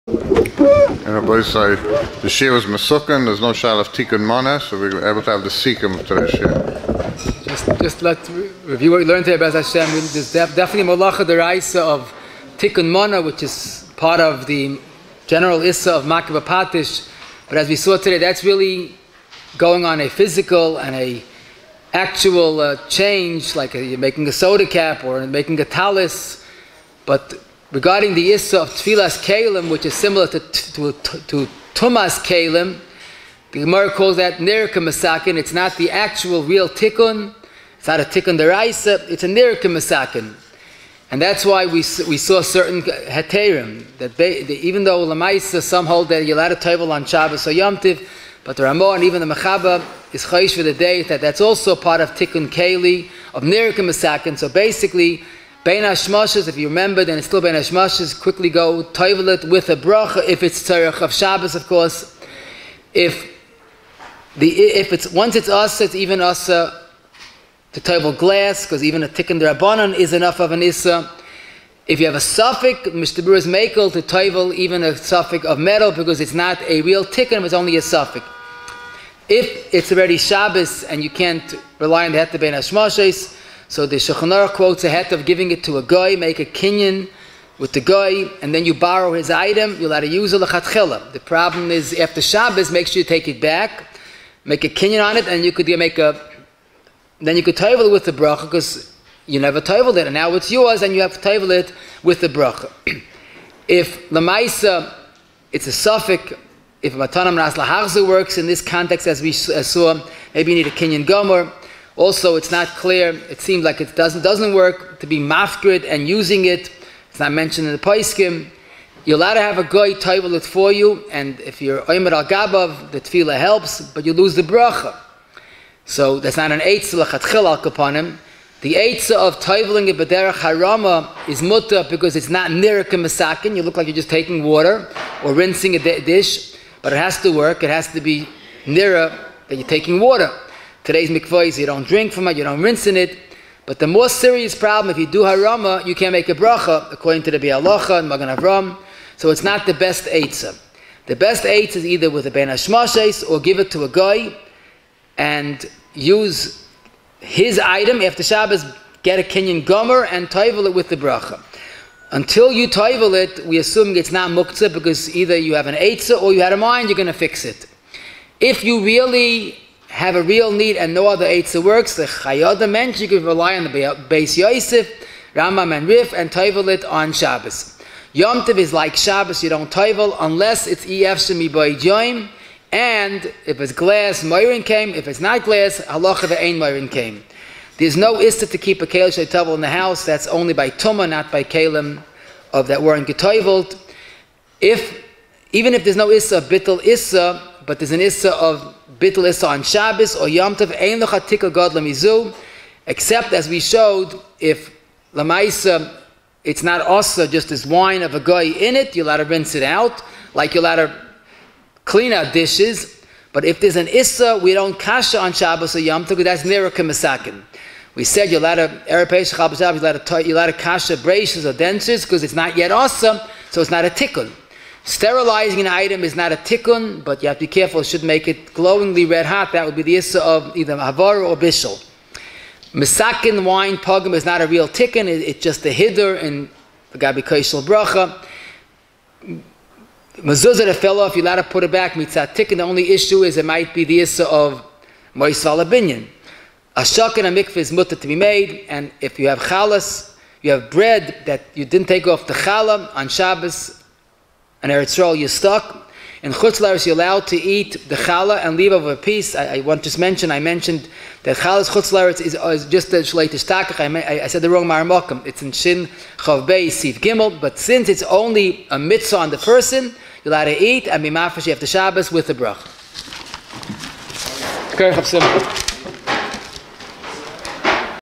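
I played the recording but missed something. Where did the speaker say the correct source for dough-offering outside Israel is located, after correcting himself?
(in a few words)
Shin Chav Bey, Sif Gimel.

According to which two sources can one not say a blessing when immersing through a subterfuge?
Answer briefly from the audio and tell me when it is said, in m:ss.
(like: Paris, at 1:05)
Biur Halacha and Magen Avraham, at 2:27.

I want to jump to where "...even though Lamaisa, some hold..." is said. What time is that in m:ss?
0:44.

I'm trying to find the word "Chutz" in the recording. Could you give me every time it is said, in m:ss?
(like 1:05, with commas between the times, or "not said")
4:16, 4:21.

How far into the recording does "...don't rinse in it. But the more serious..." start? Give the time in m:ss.
2:22.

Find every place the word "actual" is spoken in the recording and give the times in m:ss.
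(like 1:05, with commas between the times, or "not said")
0:21, 0:35.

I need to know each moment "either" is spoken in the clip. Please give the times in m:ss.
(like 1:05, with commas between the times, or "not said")
2:31, 2:45, 3:50.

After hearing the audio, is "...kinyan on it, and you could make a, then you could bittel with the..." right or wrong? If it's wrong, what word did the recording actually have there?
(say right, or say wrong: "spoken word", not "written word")
wrong: "toivel", not "bittel".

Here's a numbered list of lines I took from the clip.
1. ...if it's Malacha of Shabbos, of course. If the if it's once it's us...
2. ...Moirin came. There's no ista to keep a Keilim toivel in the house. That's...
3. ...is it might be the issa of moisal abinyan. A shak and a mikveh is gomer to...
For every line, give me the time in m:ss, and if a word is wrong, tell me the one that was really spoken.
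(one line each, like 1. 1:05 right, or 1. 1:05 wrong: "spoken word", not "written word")
1. 1:00 wrong: "Tzarech", not "Malacha"
2. 3:06 wrong: "Kalesh", not "Keilim"
3. 4:03 wrong: "mutter", not "gomer".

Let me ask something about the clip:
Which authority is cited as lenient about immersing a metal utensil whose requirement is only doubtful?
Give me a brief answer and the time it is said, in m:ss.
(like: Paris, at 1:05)
Mishnah Berurah, at 1:12.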